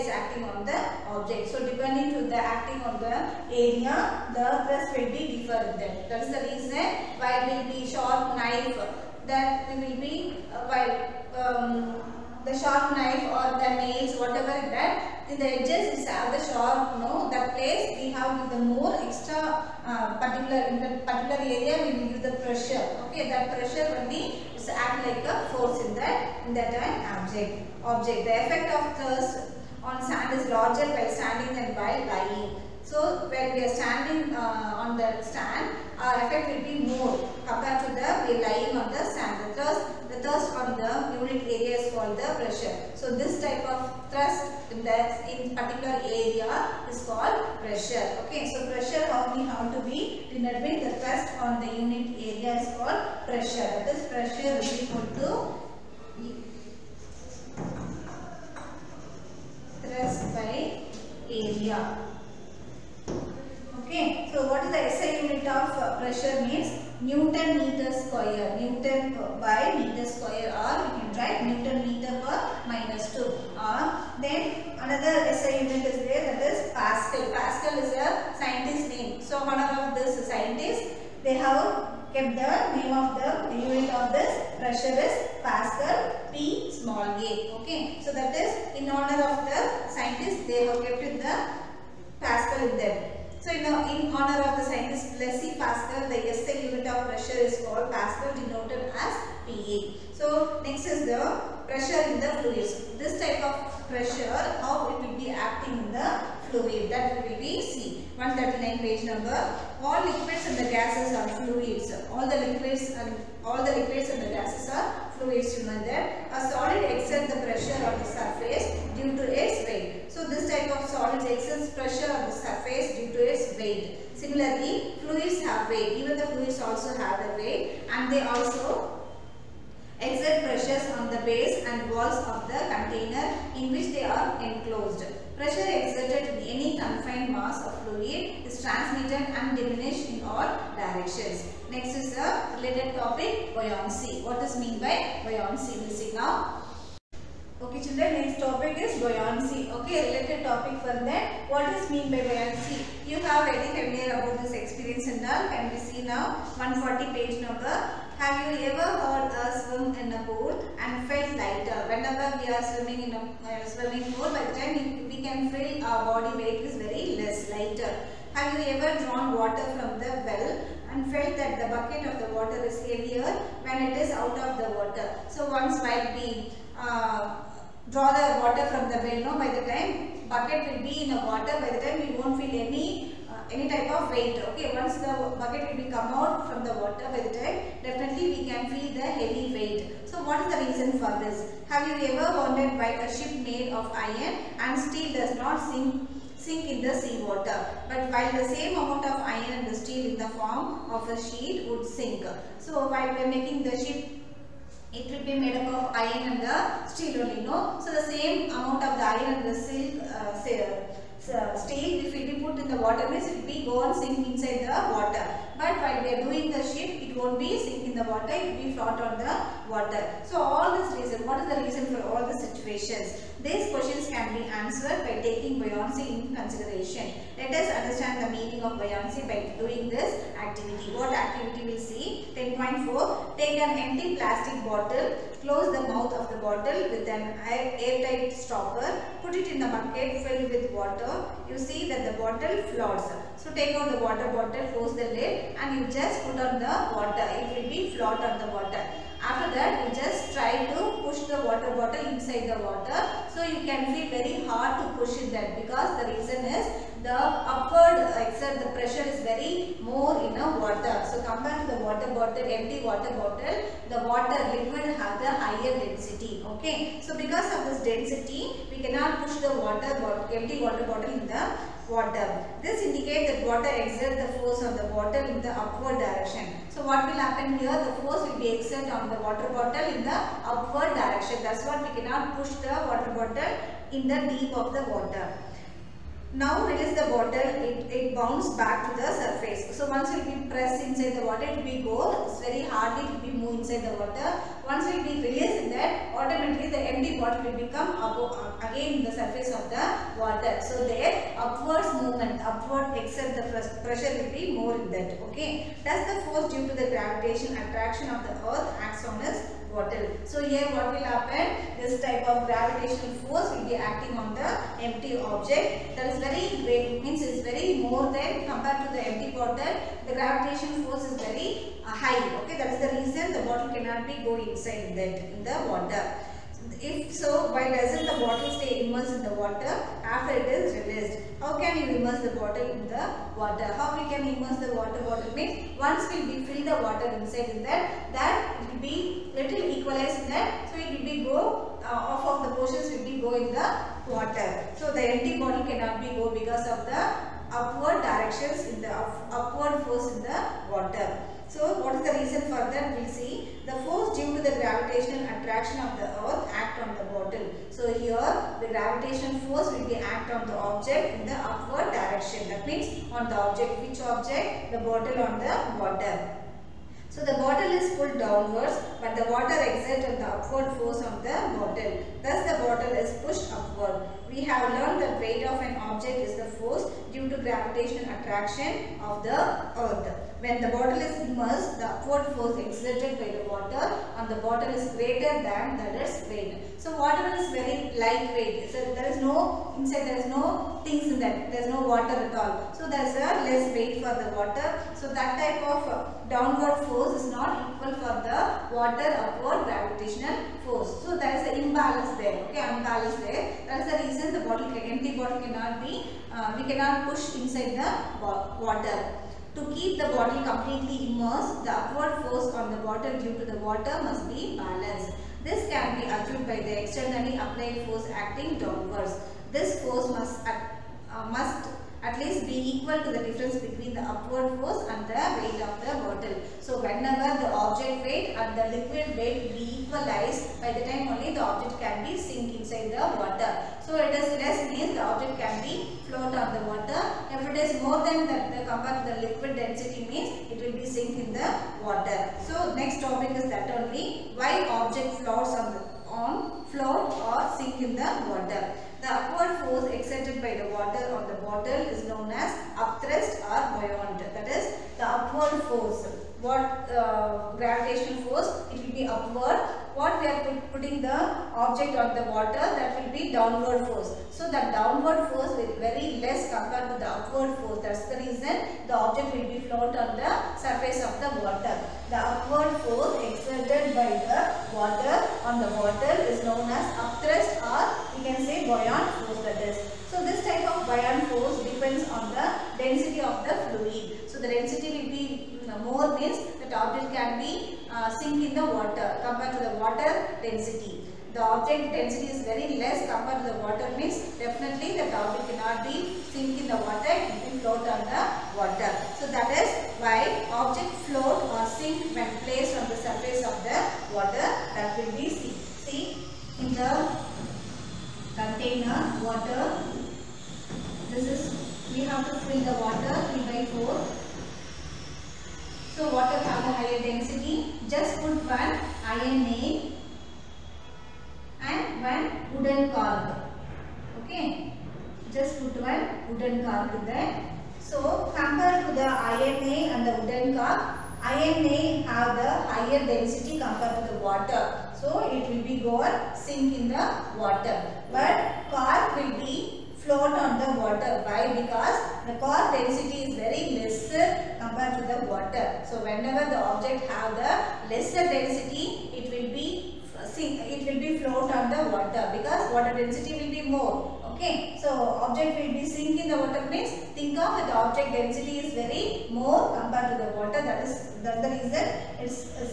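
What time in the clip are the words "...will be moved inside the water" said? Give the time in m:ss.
4:53.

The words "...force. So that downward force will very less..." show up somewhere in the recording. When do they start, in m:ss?
7:43.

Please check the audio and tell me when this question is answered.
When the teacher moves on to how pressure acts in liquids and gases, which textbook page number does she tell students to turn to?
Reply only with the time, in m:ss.
1:48.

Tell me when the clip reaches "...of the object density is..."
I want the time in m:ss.
9:17.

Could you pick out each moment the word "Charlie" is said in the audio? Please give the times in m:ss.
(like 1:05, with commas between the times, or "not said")
not said.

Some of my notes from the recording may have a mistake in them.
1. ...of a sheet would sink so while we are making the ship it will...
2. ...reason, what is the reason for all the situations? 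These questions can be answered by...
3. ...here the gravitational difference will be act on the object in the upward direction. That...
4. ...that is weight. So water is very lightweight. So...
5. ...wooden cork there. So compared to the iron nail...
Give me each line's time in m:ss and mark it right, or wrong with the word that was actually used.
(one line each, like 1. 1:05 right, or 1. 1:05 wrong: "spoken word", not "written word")
1. 3:20 right
2. 3:40 right
3. 5:57 wrong: "force", not "difference"
4. 6:25 right
5. 8:46 right.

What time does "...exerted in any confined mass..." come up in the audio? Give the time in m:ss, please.
2:15.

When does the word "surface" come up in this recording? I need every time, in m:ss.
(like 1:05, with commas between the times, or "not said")
4:49, 4:59, 7:50, 8:23.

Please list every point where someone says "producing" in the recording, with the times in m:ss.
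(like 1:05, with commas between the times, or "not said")
not said.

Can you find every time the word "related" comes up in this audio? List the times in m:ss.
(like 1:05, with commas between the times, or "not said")
2:22, 2:30.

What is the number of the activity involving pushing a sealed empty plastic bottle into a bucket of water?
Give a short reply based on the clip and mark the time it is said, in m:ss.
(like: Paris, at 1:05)
10.4, at 3:52.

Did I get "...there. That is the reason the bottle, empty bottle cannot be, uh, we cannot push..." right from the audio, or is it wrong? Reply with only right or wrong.
right.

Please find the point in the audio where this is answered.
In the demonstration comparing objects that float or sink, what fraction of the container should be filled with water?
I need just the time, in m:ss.
8:33.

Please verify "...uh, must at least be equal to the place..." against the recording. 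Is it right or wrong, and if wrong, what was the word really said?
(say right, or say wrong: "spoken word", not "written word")
wrong: "difference", not "place".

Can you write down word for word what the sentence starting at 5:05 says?
Thus the force due to the gravitation attraction of the earth acts on us bottle.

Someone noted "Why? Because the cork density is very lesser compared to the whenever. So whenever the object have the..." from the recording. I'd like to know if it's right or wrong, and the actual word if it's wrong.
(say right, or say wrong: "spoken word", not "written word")
wrong: "water", not "whenever".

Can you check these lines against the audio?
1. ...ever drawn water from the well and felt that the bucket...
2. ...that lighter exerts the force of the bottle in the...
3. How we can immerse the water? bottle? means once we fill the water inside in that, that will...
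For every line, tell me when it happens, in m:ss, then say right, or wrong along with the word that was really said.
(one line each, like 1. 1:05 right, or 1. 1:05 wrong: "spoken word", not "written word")
1. 2:48 right
2. 4:33 wrong: "water", not "lighter"
3. 5:33 right.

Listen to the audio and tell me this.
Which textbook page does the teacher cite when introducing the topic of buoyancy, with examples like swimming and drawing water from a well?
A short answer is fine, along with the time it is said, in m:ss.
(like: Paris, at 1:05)
140, at 2:36.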